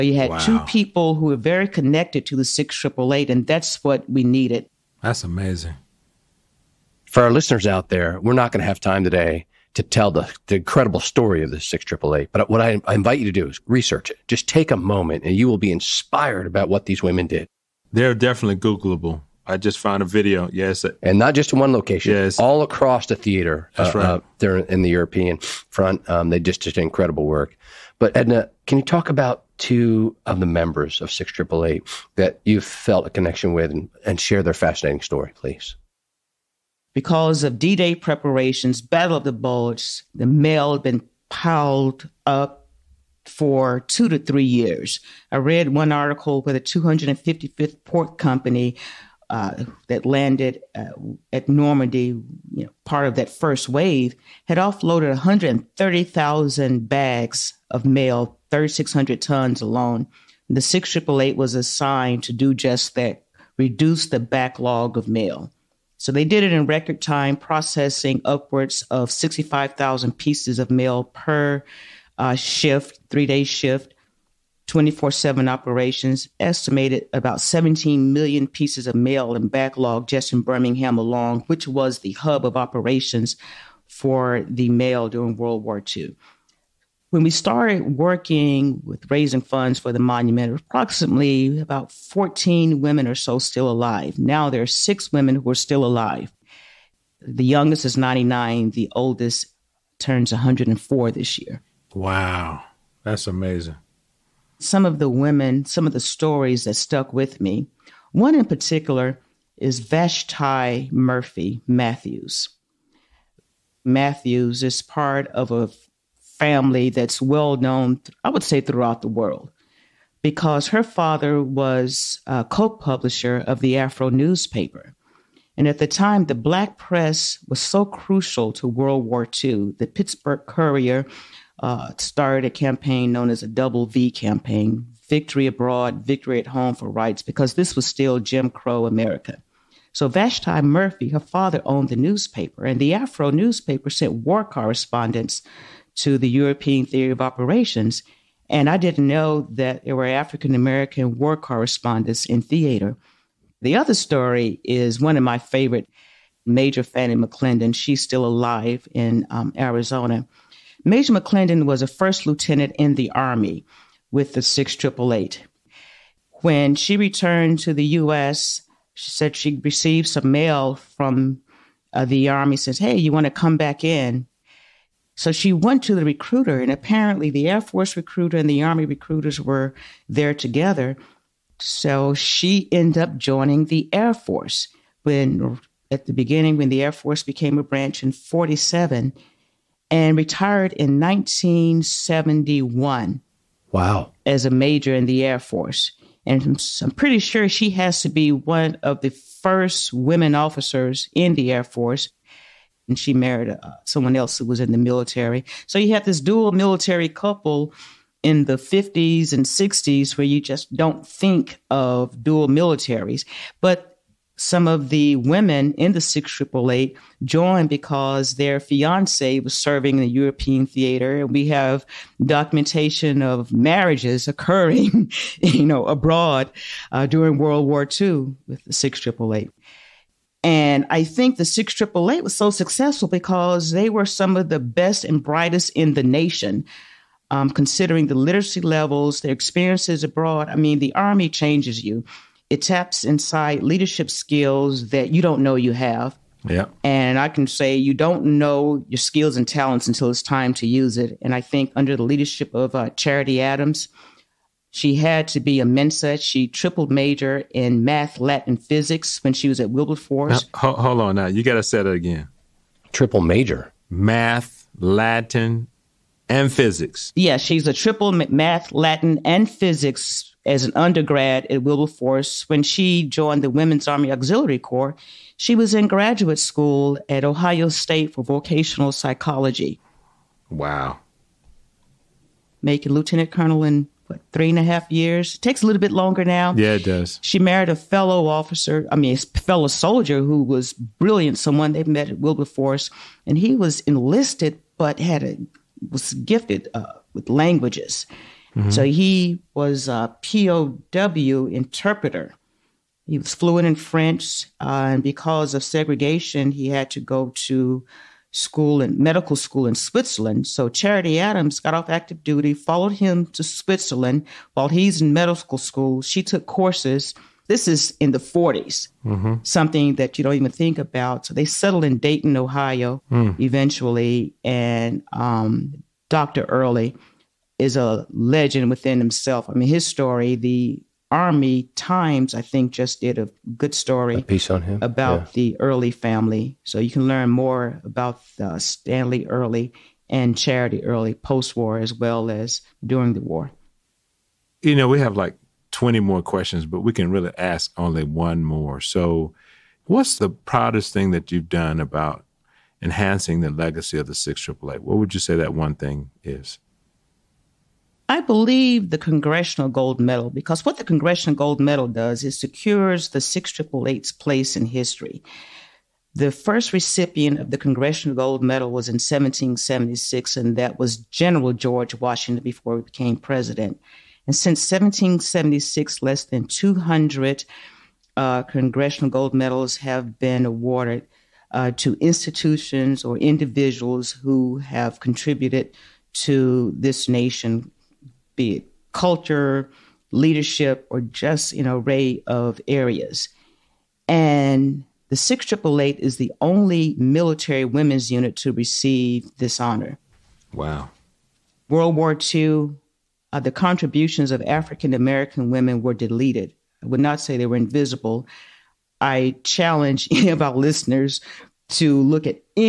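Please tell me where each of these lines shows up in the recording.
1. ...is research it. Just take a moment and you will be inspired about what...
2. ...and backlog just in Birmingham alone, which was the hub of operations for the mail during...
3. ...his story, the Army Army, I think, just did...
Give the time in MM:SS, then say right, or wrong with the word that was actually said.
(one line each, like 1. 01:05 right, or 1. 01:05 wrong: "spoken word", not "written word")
1. 00:13 right
2. 01:19 right
3. 05:29 wrong: "Times", not "Army".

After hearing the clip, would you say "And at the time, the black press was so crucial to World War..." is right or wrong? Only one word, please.
right.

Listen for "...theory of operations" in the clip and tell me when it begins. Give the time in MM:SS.
02:26.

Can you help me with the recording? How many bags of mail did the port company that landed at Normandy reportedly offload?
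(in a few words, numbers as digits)
130,000.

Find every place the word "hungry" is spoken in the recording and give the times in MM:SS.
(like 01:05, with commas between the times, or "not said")
not said.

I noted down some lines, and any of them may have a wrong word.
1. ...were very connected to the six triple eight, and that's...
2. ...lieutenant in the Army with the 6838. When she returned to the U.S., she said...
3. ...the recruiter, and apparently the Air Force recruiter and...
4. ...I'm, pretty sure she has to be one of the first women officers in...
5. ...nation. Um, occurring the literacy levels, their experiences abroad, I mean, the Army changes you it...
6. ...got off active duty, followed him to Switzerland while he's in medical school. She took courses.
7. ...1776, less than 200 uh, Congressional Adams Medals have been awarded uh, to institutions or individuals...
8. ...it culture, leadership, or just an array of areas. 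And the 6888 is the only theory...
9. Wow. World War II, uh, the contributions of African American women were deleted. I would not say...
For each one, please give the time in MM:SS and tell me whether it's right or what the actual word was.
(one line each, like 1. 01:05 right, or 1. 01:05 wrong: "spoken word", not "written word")
1. 00:01 right
2. 02:42 wrong: "6888", not "6838"
3. 02:55 right
4. 03:16 right
5. 03:56 wrong: "considering", not "occurring"
6. 05:11 right
7. 06:14 wrong: "Gold", not "Adams"
8. 06:28 wrong: "military", not "theory"
9. 06:40 right.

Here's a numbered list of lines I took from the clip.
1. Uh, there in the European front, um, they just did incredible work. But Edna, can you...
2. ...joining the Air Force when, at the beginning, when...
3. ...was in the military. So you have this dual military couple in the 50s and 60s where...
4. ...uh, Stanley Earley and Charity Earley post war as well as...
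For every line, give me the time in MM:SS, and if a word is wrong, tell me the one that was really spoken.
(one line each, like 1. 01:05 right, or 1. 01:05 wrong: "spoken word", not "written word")
1. 00:24 right
2. 03:03 right
3. 03:24 right
4. 05:38 right.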